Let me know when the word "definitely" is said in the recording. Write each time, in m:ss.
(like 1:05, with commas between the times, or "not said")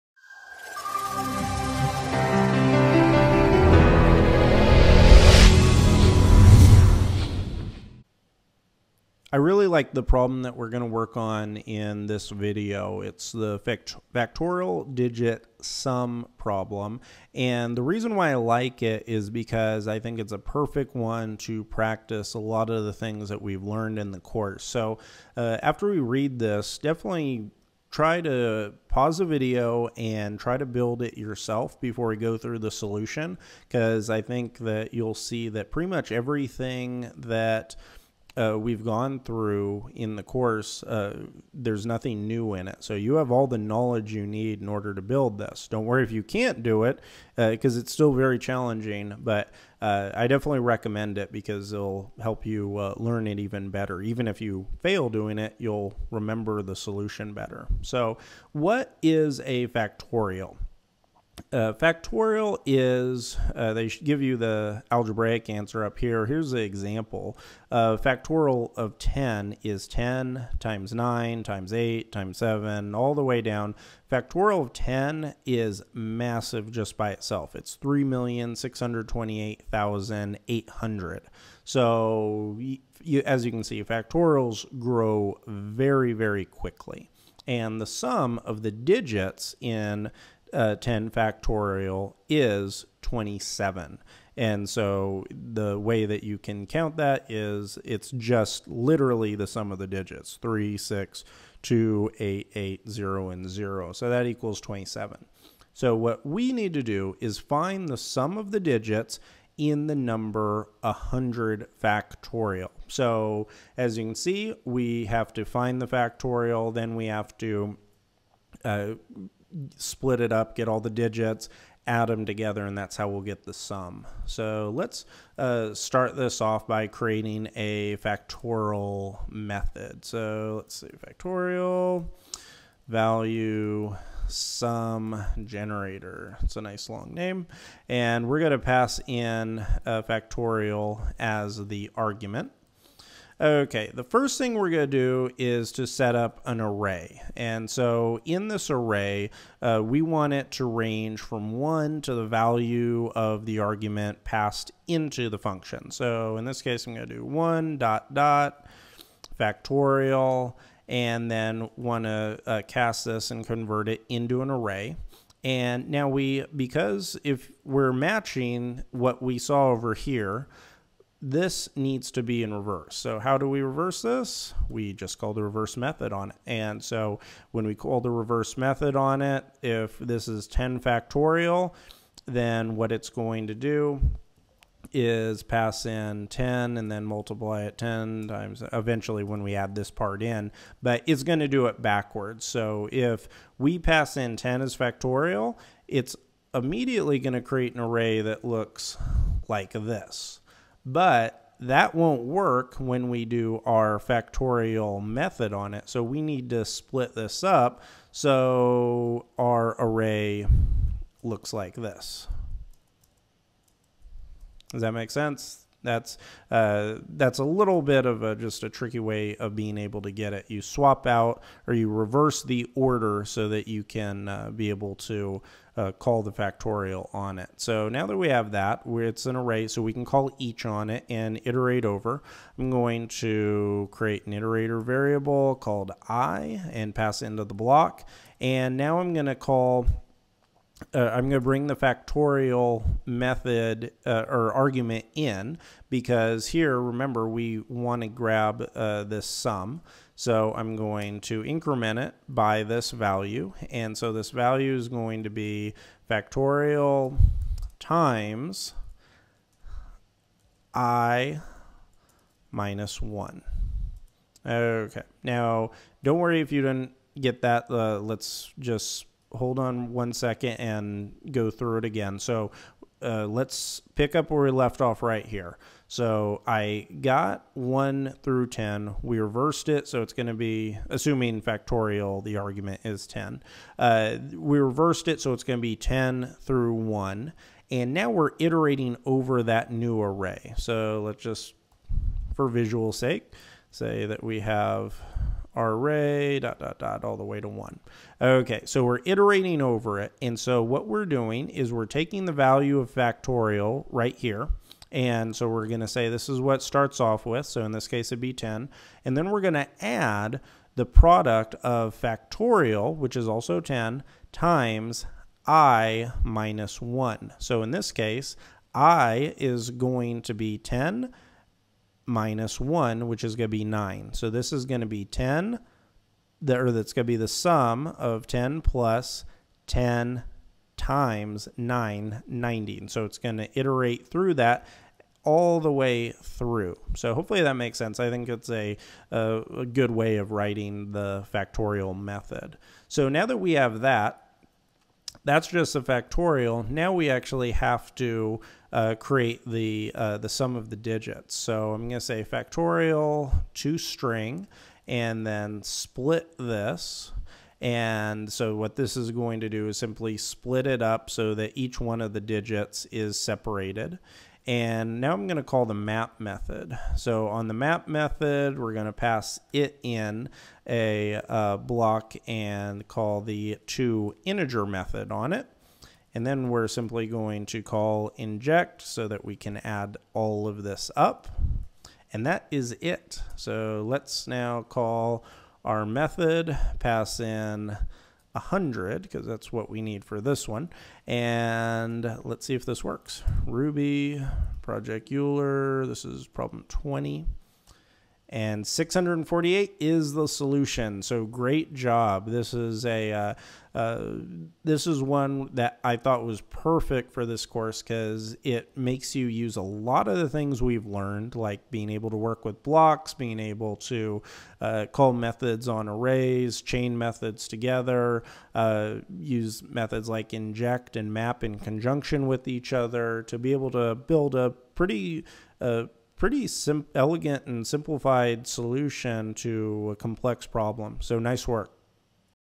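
0:26, 0:50.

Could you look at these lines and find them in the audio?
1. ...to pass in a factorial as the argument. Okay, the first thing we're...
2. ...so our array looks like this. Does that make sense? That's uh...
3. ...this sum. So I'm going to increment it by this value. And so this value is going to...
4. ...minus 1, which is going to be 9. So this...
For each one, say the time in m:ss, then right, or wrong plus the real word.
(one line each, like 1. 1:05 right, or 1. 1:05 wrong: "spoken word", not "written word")
1. 2:18 right
2. 3:28 right
3. 4:09 right
4. 5:22 right.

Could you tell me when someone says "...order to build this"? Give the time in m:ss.
0:44.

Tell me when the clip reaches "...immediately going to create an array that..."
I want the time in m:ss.
3:16.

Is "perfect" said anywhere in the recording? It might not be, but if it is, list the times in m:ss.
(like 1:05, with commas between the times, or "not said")
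0:20, 6:46.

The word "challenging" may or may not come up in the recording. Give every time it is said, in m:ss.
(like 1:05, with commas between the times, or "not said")
0:48.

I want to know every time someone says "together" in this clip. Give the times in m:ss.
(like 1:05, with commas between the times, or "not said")
2:02, 6:57.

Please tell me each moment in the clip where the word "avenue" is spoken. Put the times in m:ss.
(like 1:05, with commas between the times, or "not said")
not said.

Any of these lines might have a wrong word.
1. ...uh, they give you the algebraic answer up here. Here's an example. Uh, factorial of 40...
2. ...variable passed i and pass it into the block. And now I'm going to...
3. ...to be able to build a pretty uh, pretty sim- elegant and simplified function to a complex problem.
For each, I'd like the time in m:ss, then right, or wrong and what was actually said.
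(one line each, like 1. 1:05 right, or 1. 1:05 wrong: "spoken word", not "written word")
1. 1:03 wrong: "10", not "40"
2. 3:54 wrong: "called", not "passed"
3. 7:03 wrong: "solution", not "function".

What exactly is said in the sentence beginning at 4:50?
So let's just, for visual sake, say that we have array dot dot dot all the way to one.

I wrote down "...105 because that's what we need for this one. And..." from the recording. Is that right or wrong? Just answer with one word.
wrong.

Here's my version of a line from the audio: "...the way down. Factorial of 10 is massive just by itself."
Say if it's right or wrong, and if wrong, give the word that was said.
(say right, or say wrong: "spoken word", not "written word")
right.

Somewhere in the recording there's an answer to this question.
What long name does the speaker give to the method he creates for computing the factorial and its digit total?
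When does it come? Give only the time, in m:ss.
2:10.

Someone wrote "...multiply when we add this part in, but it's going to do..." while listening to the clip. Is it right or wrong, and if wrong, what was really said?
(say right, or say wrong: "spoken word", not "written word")
wrong: "eventually", not "multiply".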